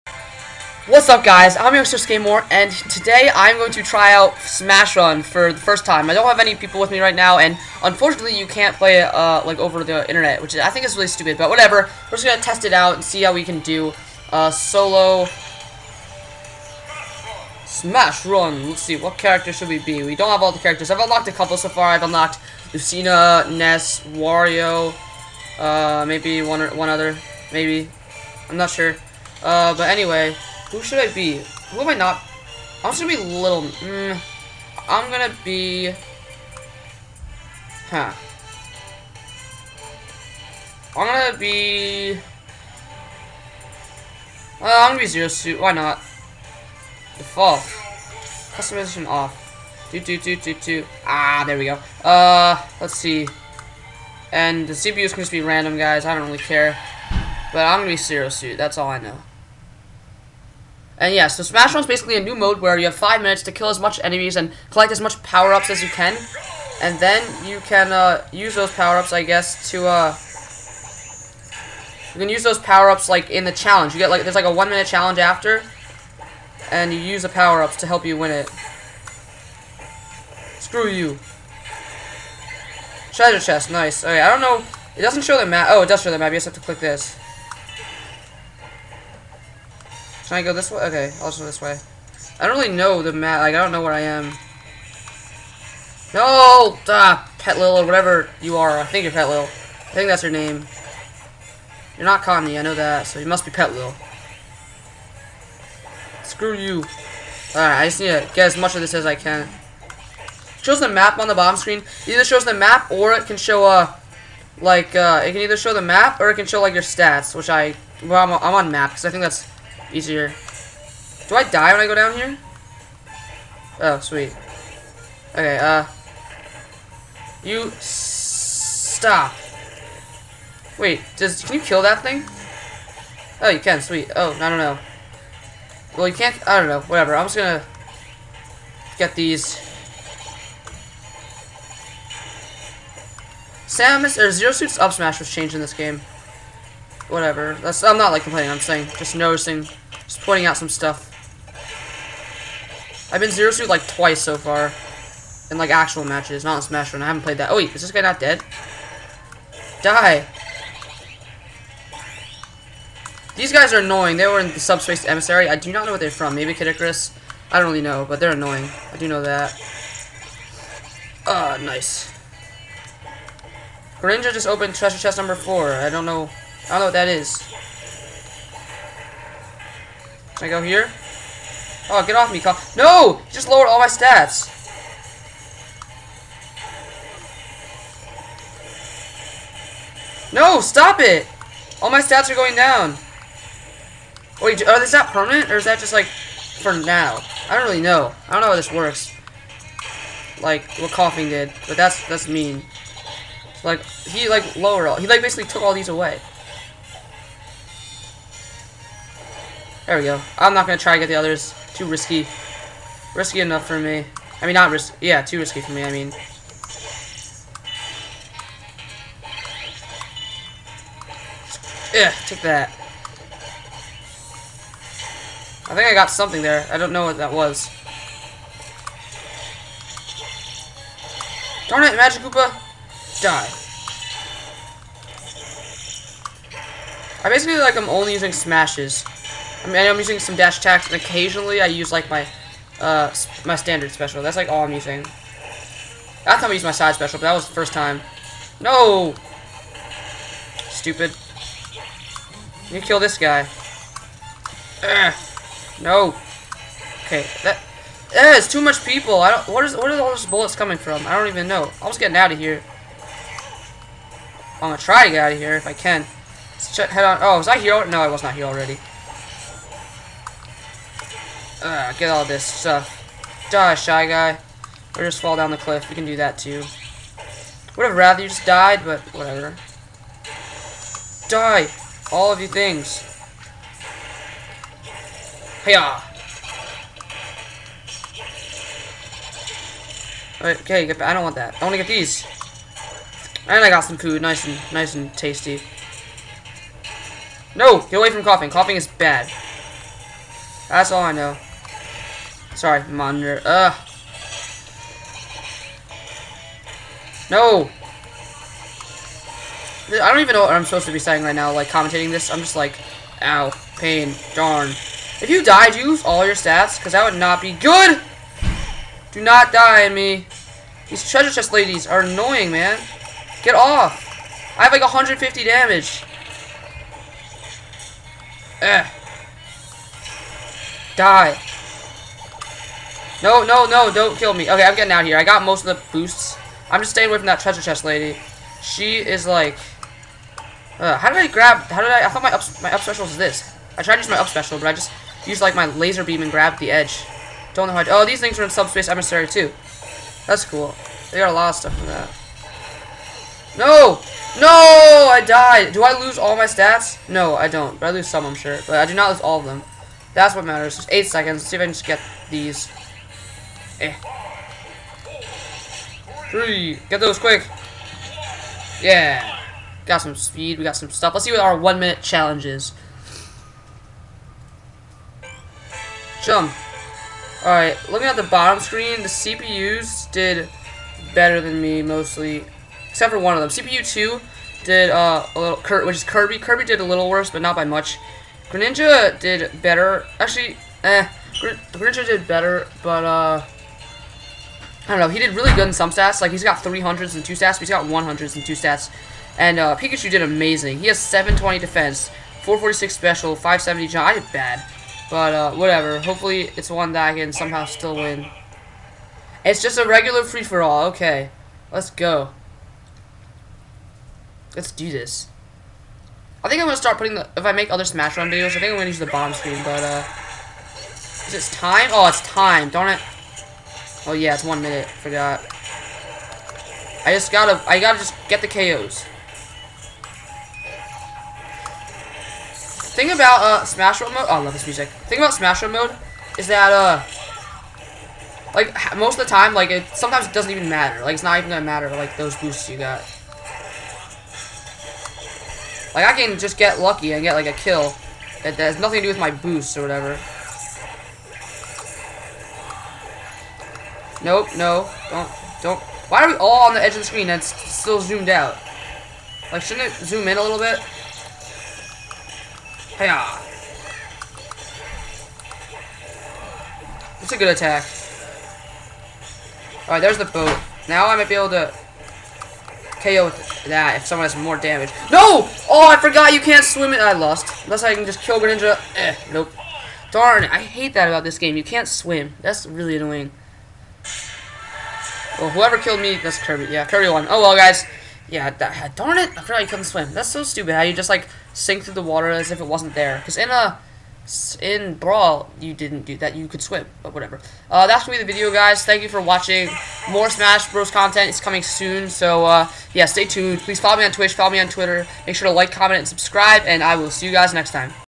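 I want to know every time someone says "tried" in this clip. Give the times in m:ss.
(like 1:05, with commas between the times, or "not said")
5:43.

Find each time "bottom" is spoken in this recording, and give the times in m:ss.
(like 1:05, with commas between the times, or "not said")
1:51, 6:18.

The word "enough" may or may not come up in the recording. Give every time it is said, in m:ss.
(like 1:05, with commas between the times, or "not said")
3:33.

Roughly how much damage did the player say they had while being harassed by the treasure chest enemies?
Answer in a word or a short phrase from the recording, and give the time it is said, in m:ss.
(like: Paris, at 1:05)
150, at 5:24.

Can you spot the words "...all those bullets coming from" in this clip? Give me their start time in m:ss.
4:20.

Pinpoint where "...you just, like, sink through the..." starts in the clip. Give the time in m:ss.
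8:10.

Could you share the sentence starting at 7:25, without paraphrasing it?
Like I can just get lucky and get like a kill that has nothing to do with my boosts or whatever.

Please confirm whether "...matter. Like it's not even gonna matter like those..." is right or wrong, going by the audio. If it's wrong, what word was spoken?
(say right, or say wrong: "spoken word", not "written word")
right.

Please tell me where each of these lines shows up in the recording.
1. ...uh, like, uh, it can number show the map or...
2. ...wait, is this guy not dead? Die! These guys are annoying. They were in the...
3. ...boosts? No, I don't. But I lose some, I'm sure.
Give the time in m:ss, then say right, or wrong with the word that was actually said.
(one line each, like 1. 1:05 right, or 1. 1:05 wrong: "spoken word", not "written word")
1. 1:53 wrong: "either", not "number"
2. 2:37 right
3. 5:56 wrong: "stats", not "boosts".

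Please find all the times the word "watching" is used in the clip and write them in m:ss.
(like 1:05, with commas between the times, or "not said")
8:19.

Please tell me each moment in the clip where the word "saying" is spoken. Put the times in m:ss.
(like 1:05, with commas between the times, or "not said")
2:28, 5:10.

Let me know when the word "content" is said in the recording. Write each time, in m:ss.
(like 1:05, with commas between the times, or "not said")
8:20.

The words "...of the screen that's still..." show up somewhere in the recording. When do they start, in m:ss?
7:36.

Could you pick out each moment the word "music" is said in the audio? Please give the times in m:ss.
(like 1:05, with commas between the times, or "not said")
7:14.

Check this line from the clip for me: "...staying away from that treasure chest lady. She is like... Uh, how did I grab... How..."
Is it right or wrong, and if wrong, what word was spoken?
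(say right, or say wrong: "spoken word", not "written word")
right.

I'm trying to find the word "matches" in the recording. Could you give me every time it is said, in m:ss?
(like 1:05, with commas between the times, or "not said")
2:36.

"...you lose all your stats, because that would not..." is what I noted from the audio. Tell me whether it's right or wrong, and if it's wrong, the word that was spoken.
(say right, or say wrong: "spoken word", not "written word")
right.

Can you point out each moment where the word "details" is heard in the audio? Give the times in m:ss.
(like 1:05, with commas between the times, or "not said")
not said.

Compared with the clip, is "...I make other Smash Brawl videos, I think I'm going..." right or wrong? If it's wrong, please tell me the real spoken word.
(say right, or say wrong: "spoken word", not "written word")
wrong: "Run", not "Brawl".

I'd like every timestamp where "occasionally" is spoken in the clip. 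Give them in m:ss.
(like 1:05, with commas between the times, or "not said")
4:00.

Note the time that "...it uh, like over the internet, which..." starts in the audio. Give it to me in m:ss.
0:08.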